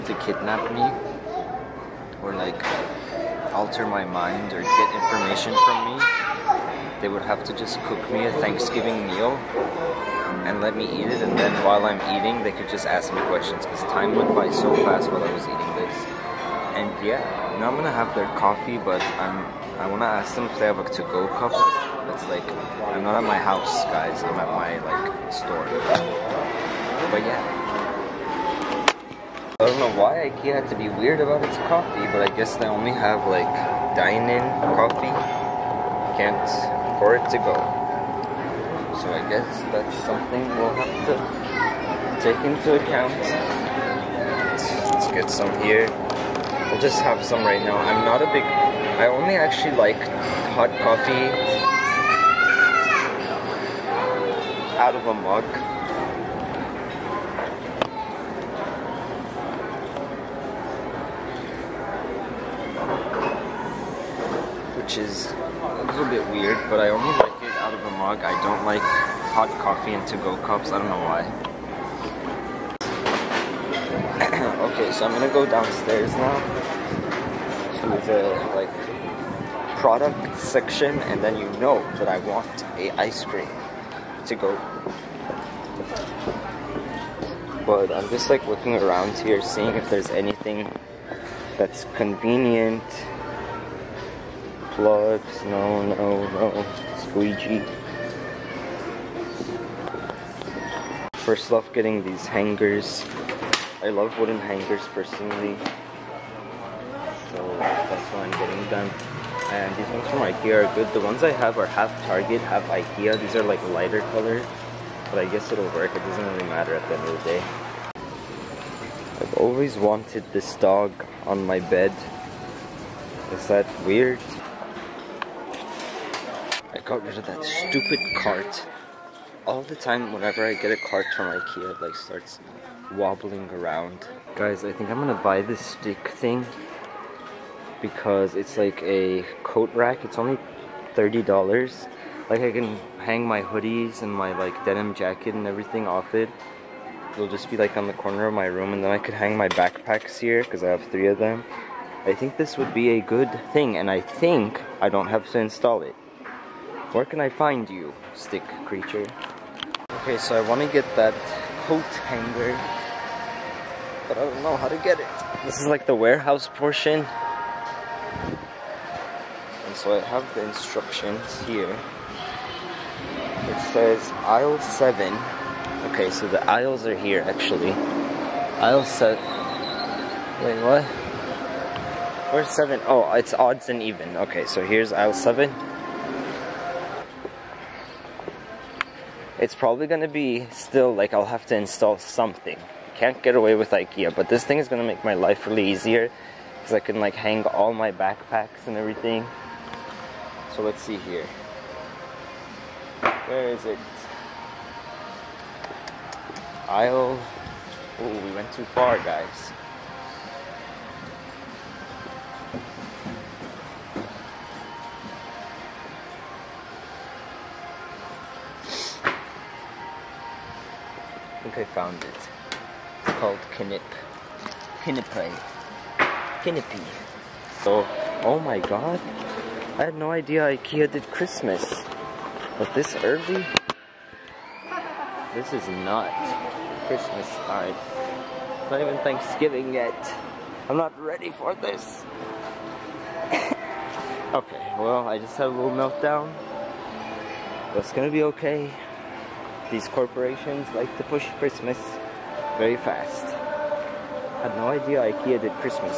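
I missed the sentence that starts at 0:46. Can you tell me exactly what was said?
We'll just have some right now.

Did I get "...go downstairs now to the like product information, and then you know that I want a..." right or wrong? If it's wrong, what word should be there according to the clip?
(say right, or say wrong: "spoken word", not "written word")
wrong: "section", not "information".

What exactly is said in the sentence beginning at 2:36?
Where can I find you, stick creature?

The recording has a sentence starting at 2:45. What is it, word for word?
This is like the warehouse portion.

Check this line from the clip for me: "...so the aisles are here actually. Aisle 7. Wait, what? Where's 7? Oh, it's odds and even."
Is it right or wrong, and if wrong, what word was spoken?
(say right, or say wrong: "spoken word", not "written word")
right.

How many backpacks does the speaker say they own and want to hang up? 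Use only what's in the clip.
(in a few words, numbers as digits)
3.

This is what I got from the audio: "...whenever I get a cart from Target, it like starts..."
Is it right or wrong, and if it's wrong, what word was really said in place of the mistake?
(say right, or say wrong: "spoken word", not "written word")
wrong: "Ikea", not "Target".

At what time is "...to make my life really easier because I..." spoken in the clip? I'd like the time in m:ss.
3:14.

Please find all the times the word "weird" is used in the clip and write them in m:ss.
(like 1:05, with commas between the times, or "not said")
0:30, 2:03.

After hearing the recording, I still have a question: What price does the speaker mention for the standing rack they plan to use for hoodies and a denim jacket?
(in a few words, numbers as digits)
$30.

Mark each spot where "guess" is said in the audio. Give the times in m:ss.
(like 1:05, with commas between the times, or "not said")
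0:32, 0:39, 1:55.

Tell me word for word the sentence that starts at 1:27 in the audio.
But I'm just like looking around here, seeing if there's anything that's convenient plugs.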